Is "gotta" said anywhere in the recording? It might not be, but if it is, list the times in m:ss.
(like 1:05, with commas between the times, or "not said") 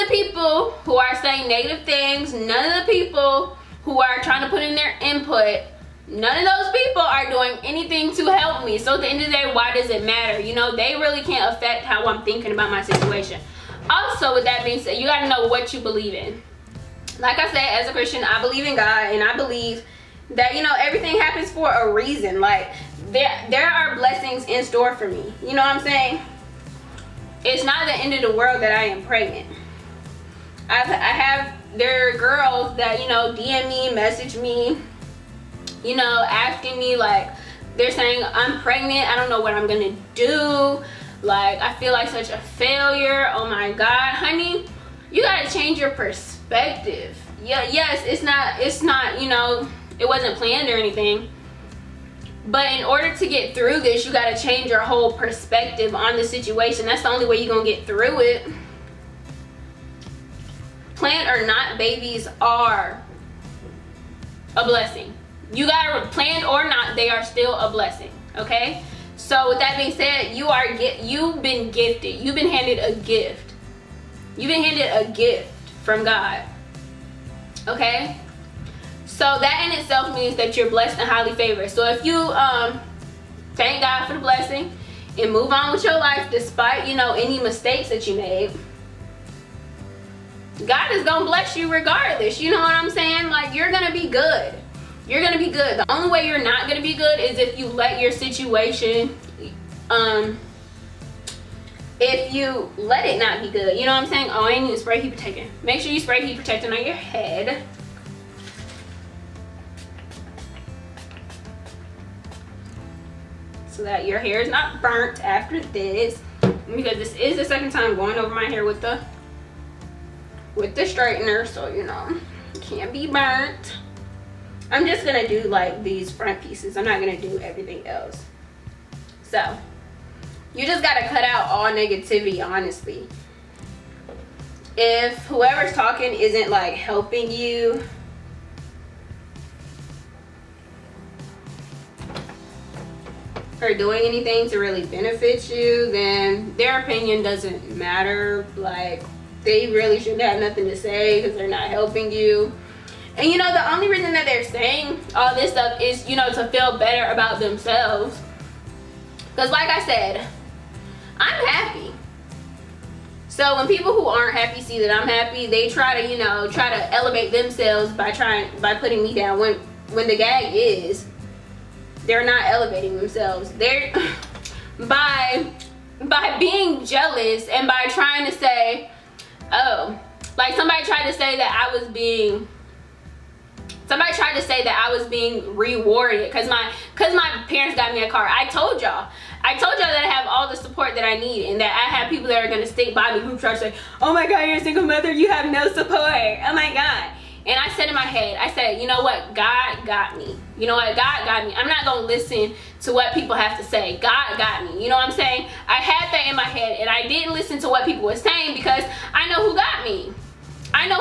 0:45, 2:10.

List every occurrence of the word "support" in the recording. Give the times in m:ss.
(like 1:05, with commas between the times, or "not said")
3:10, 3:15.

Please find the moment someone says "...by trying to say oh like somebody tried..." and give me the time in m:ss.
2:57.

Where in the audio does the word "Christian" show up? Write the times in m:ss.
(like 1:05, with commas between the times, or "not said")
0:17.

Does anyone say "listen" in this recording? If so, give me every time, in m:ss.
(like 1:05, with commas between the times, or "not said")
3:22, 3:27.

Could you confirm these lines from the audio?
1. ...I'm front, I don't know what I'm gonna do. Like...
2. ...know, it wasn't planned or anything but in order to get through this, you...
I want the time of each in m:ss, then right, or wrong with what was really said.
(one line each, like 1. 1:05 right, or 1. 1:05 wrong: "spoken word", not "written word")
1. 0:38 wrong: "pregnant", not "front"
2. 0:49 right.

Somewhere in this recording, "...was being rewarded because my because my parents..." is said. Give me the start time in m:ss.
3:04.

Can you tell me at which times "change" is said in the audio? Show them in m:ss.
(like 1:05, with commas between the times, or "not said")
0:45, 0:54.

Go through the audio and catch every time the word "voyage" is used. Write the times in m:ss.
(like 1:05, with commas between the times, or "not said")
not said.